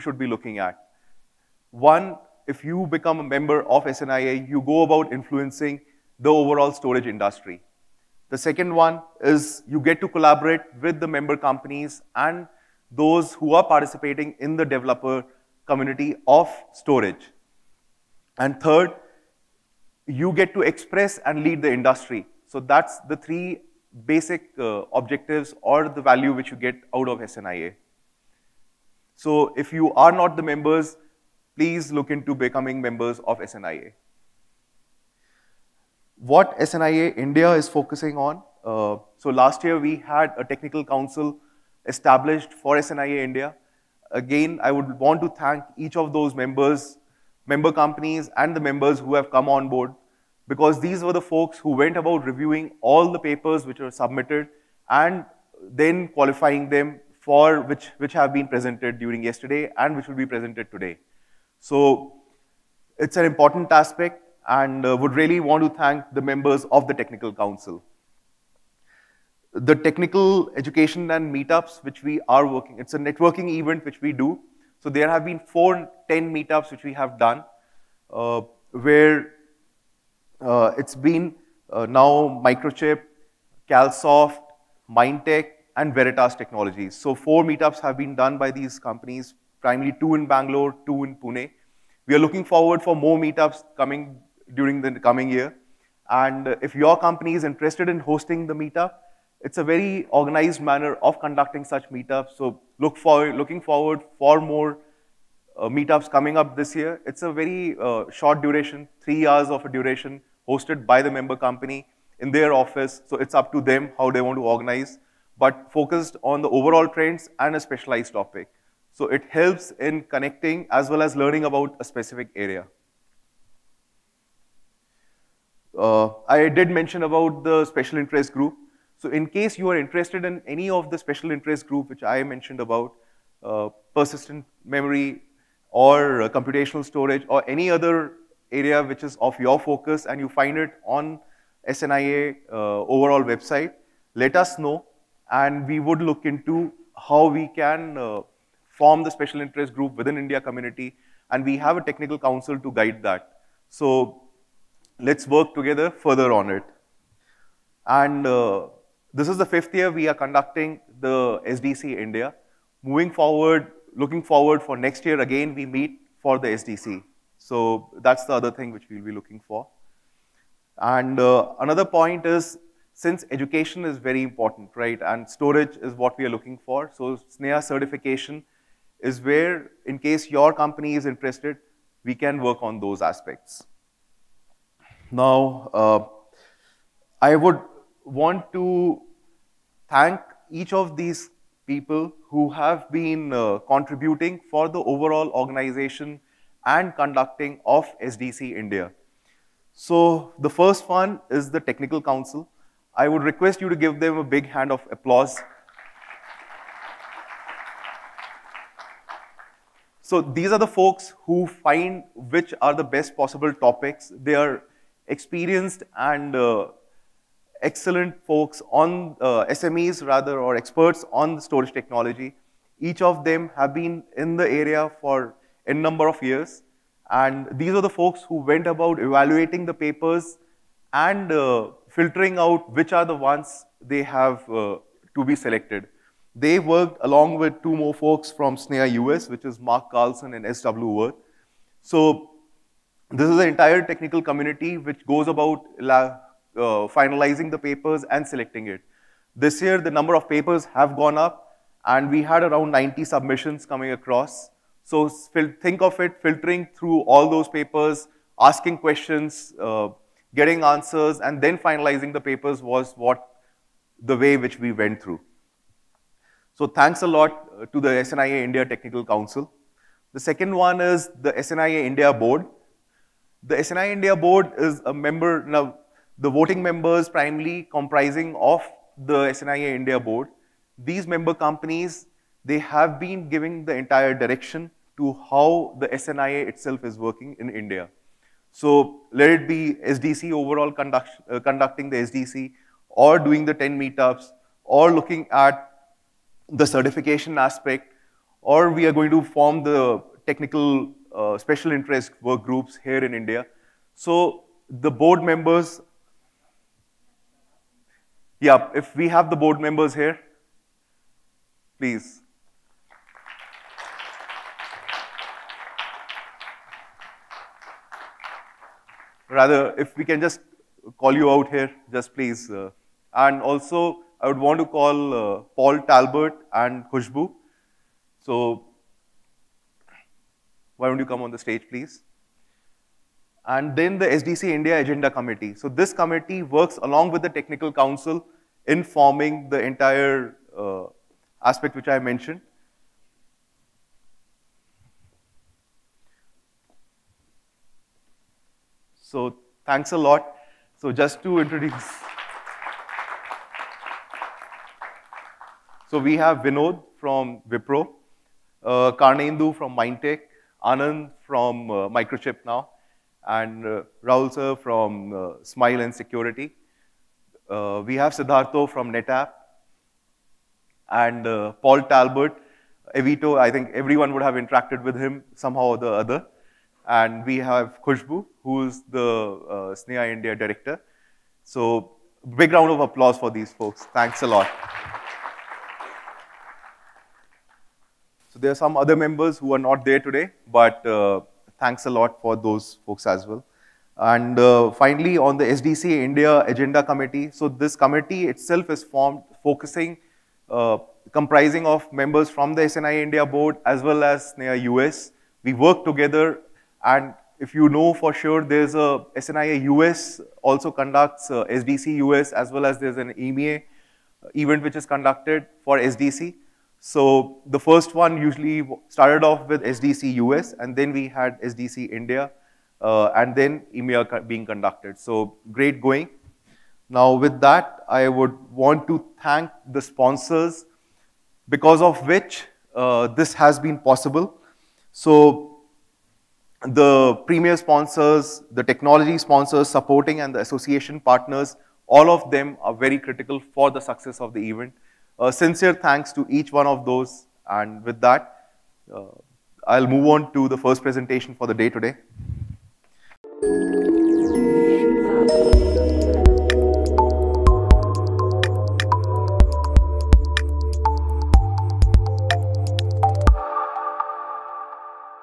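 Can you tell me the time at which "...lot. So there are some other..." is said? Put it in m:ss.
6:24.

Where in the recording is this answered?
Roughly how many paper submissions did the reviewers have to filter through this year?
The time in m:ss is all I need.
4:12.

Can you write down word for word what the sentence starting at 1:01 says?
So it's an important aspect and uh, would really want to thank the members of the Technical Council.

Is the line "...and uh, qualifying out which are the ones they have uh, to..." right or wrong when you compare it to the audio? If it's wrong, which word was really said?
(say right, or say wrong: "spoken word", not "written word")
wrong: "filtering", not "qualifying".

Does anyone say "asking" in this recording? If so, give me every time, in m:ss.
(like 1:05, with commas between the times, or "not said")
4:18.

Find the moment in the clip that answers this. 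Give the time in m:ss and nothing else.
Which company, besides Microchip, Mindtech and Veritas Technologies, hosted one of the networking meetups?
1:23.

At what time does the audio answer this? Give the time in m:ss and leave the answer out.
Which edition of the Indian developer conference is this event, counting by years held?
2:39.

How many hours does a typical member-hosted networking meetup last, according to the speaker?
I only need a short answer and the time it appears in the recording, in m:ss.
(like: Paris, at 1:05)
3 hours, at 1:49.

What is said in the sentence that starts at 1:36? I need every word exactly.
And if your company is interested in hosting the meetup, it's a very organized manner of conducting such meetups.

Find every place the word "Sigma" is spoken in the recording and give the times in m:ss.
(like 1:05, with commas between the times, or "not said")
not said.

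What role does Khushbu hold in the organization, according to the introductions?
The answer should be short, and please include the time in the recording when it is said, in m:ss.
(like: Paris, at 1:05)
India director, at 6:20.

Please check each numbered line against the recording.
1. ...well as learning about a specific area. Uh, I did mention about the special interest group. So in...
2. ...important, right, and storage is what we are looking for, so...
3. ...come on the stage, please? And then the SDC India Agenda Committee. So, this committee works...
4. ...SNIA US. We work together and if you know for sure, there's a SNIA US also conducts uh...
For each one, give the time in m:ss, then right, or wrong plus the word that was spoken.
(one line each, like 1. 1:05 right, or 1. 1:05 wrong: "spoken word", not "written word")
1. 2:00 right
2. 2:54 right
3. 5:31 right
4. 6:44 right.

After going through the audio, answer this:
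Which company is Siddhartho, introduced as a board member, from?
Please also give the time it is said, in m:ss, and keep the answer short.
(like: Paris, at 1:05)
NetApp, at 6:08.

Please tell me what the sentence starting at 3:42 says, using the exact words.
Each of them have been in the area for n number of years.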